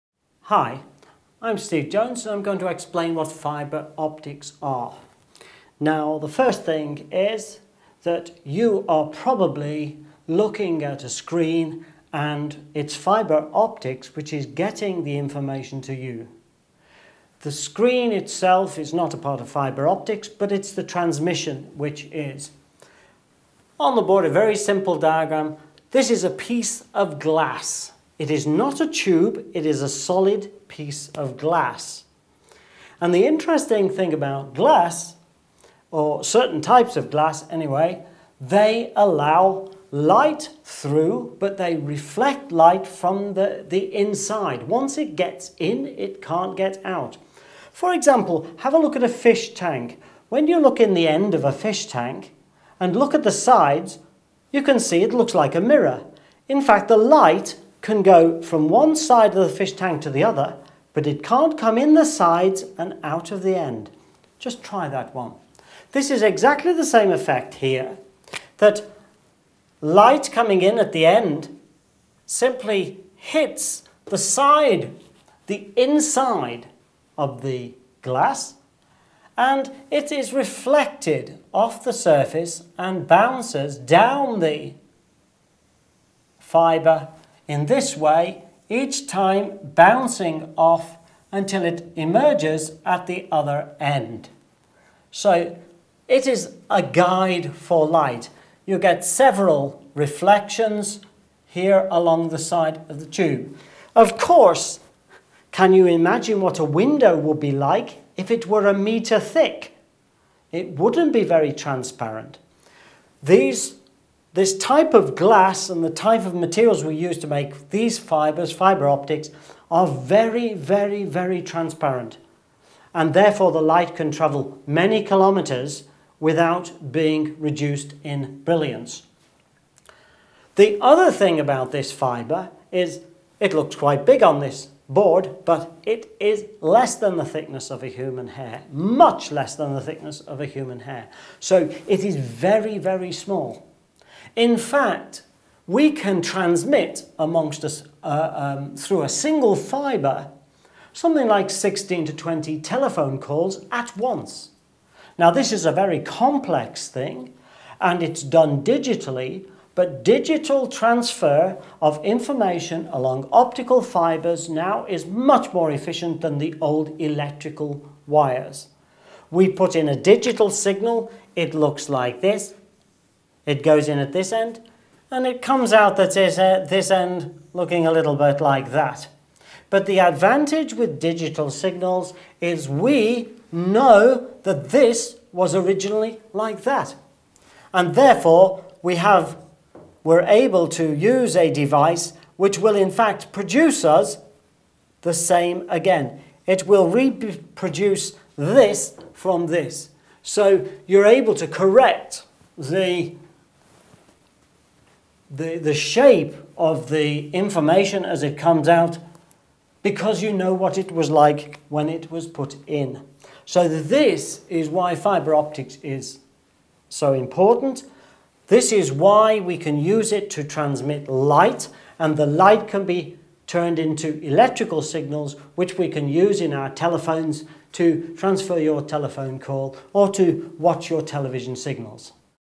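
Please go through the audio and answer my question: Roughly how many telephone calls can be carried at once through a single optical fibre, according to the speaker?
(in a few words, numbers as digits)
16 to 20.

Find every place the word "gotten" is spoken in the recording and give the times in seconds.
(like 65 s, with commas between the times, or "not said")
not said.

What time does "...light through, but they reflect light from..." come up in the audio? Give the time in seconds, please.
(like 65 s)
39 s.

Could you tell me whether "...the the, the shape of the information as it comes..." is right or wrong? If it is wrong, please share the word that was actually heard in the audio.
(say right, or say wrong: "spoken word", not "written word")
right.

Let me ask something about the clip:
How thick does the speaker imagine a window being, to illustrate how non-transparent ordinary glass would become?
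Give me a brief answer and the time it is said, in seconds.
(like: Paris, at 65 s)
a metre, at 108 s.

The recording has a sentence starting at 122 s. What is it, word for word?
And therefore the light can travel many kilometers without being reduced in brilliance.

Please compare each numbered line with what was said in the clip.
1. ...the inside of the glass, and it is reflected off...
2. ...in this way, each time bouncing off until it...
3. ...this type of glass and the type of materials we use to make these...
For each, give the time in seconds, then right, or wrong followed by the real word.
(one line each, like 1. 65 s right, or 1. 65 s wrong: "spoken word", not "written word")
1. 75 s right
2. 87 s right
3. 114 s right.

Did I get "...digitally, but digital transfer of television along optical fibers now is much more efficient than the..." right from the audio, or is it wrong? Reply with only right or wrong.
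wrong.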